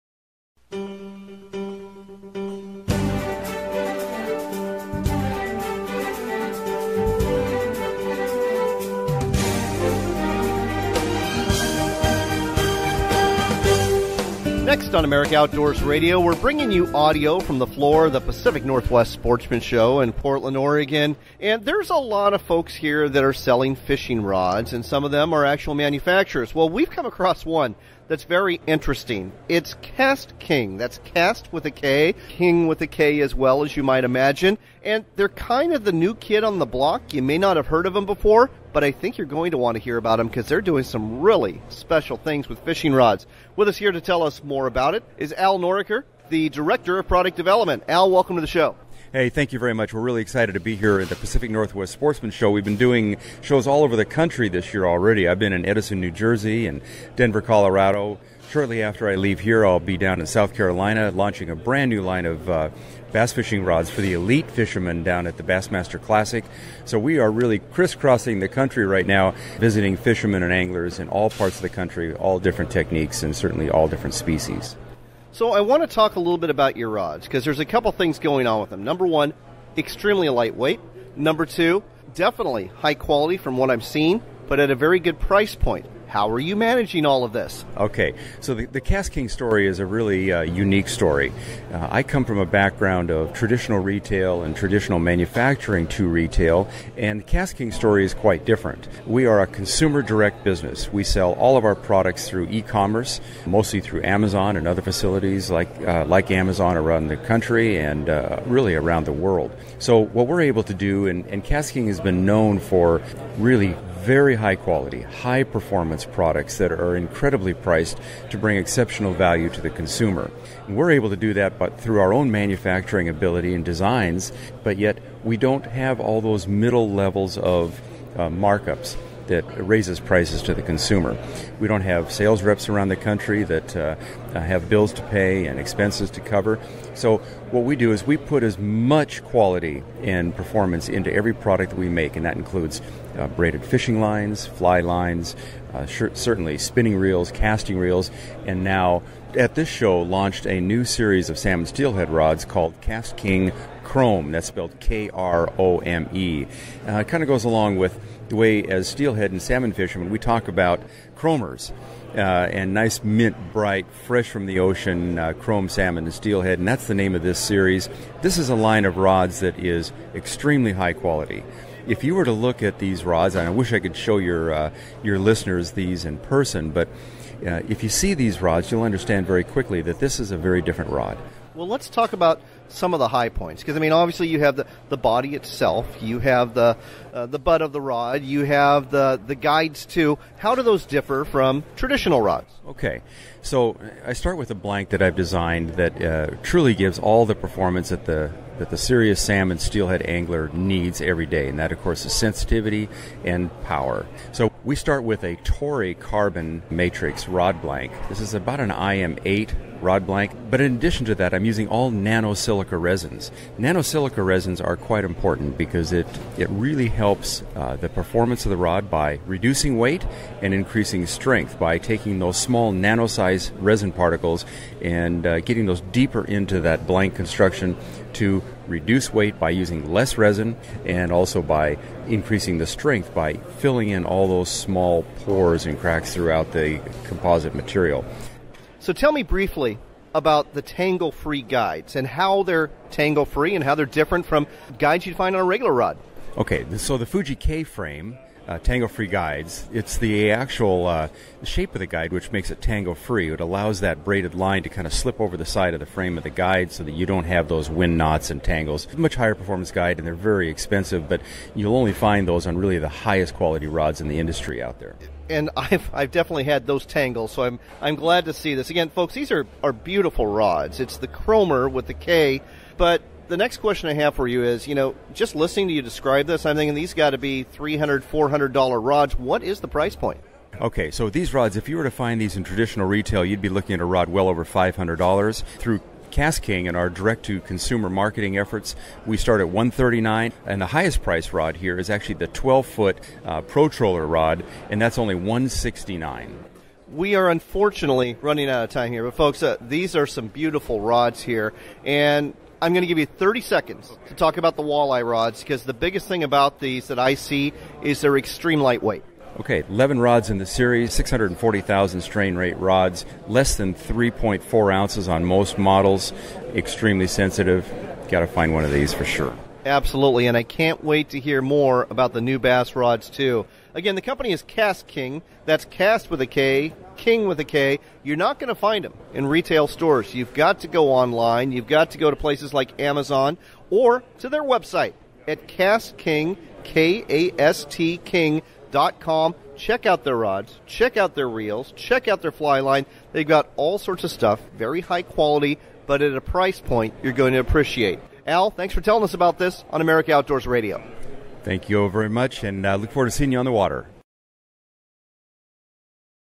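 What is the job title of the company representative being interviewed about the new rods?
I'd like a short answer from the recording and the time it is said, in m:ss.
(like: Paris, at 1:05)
Director of Product Development, at 0:46.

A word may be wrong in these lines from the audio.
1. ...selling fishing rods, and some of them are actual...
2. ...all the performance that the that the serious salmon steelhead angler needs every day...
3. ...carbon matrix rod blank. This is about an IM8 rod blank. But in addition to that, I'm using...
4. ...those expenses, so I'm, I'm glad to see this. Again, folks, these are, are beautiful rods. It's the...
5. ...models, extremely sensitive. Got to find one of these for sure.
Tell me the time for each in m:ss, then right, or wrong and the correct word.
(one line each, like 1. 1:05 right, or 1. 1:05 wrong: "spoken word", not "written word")
1. 0:23 right
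2. 3:16 right
3. 3:25 right
4. 4:26 wrong: "tangles", not "expenses"
5. 5:15 right.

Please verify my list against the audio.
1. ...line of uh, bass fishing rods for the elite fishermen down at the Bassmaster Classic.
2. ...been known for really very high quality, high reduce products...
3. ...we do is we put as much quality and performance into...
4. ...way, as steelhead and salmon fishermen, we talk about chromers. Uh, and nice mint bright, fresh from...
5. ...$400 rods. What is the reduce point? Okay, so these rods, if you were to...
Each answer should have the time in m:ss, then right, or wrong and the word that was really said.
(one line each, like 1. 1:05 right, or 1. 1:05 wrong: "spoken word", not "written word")
1. 1:02 right
2. 1:52 wrong: "performance", not "reduce"
3. 2:17 right
4. 2:38 right
5. 4:38 wrong: "price", not "reduce".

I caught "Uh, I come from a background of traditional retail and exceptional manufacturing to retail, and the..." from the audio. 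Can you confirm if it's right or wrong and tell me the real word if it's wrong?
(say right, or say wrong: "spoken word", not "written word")
wrong: "traditional", not "exceptional".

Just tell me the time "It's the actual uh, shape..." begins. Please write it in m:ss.
4:09.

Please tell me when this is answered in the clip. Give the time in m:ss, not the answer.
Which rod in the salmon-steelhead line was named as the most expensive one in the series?
4:52.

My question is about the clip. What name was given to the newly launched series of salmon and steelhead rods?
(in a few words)
KastKing Krome.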